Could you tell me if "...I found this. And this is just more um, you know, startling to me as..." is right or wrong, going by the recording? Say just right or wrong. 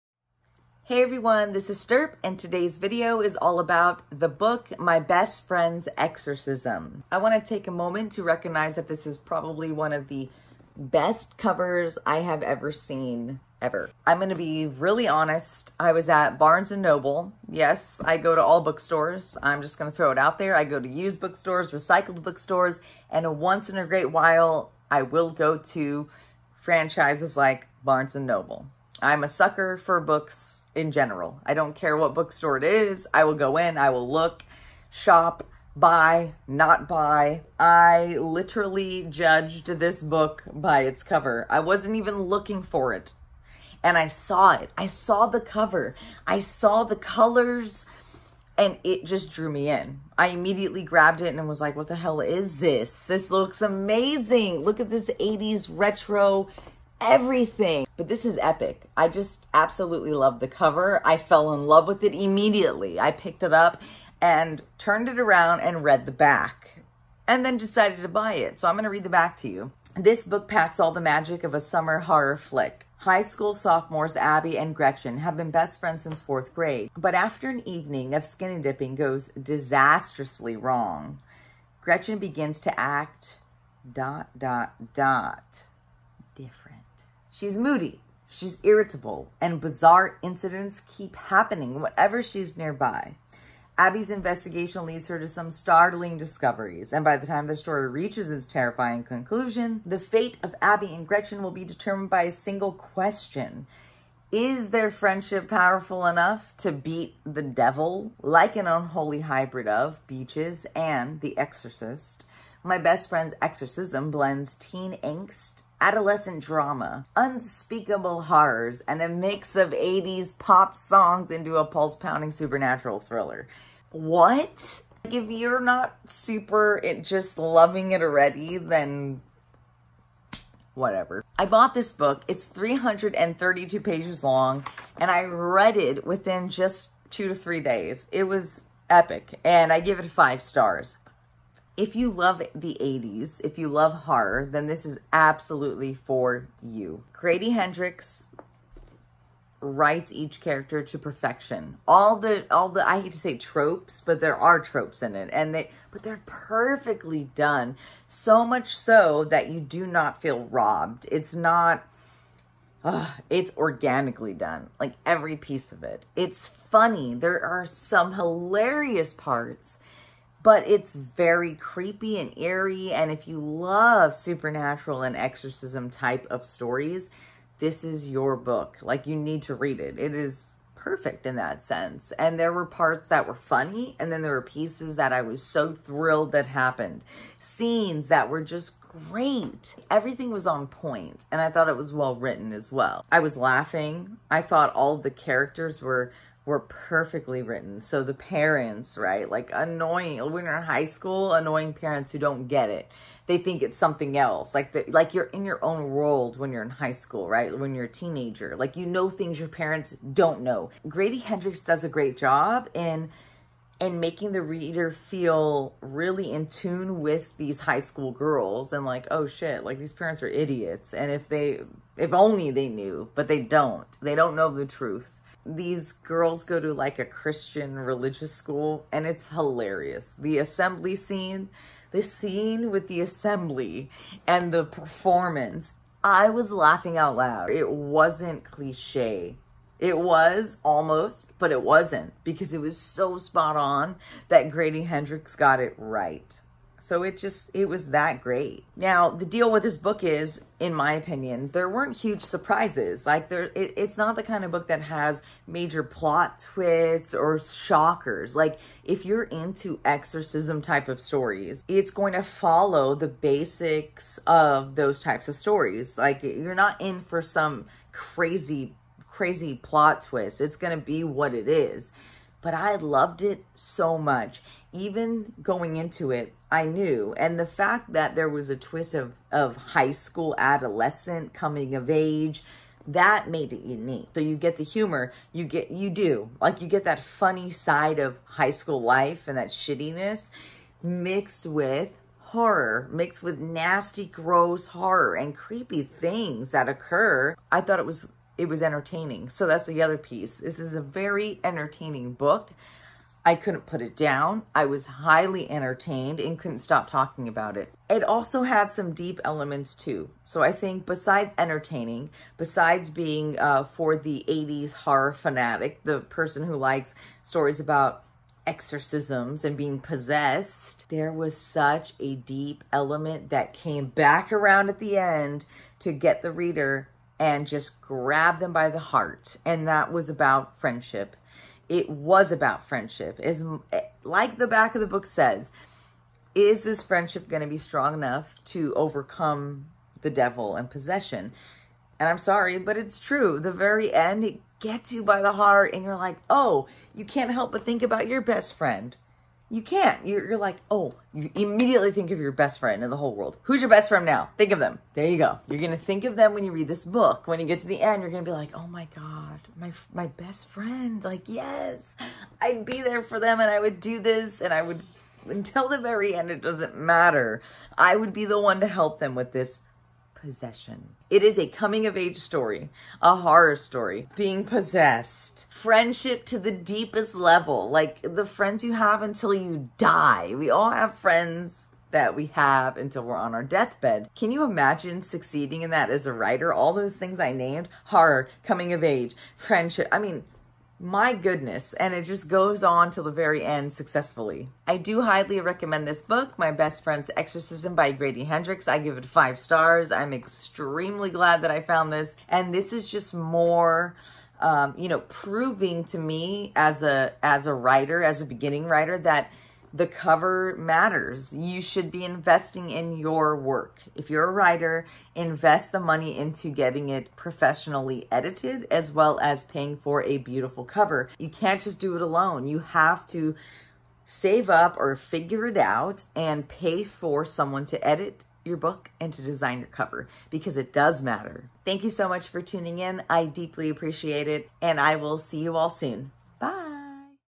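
wrong.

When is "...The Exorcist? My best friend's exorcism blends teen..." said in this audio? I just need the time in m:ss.
1:51.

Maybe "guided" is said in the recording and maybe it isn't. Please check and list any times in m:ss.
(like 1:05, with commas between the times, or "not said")
not said.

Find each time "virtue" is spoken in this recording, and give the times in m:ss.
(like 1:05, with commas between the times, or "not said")
not said.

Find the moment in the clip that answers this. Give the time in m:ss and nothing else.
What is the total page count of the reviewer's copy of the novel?
2:12.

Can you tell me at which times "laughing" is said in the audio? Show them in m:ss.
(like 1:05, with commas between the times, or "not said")
3:13, 3:56.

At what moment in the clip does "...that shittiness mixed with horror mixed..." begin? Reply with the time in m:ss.
4:49.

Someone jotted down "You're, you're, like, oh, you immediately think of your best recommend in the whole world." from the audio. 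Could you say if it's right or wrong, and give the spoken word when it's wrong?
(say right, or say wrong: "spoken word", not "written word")
wrong: "friend", not "recommend".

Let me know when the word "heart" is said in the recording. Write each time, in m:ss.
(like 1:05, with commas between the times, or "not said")
5:28, 5:45.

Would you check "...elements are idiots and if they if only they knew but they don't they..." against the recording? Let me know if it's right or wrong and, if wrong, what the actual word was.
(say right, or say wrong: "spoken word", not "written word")
wrong: "parents", not "elements".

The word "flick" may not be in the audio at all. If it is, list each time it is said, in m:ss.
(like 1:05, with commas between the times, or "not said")
1:12.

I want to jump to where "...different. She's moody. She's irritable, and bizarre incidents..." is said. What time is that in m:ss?
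1:26.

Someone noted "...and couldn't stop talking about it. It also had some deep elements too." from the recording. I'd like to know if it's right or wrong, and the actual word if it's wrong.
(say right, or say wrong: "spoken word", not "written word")
right.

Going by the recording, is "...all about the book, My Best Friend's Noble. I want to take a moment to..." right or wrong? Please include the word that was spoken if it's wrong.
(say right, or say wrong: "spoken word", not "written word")
wrong: "Exorcism", not "Noble".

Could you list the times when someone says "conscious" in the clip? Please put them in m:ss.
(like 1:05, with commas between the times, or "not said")
not said.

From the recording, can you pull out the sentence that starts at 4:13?
Like there, it, it's not the kind of book that has major plot twists or shockers.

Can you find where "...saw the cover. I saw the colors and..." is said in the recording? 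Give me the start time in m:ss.
0:44.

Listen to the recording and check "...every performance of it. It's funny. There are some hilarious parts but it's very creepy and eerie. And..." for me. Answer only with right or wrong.
wrong.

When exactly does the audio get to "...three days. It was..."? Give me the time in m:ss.
2:17.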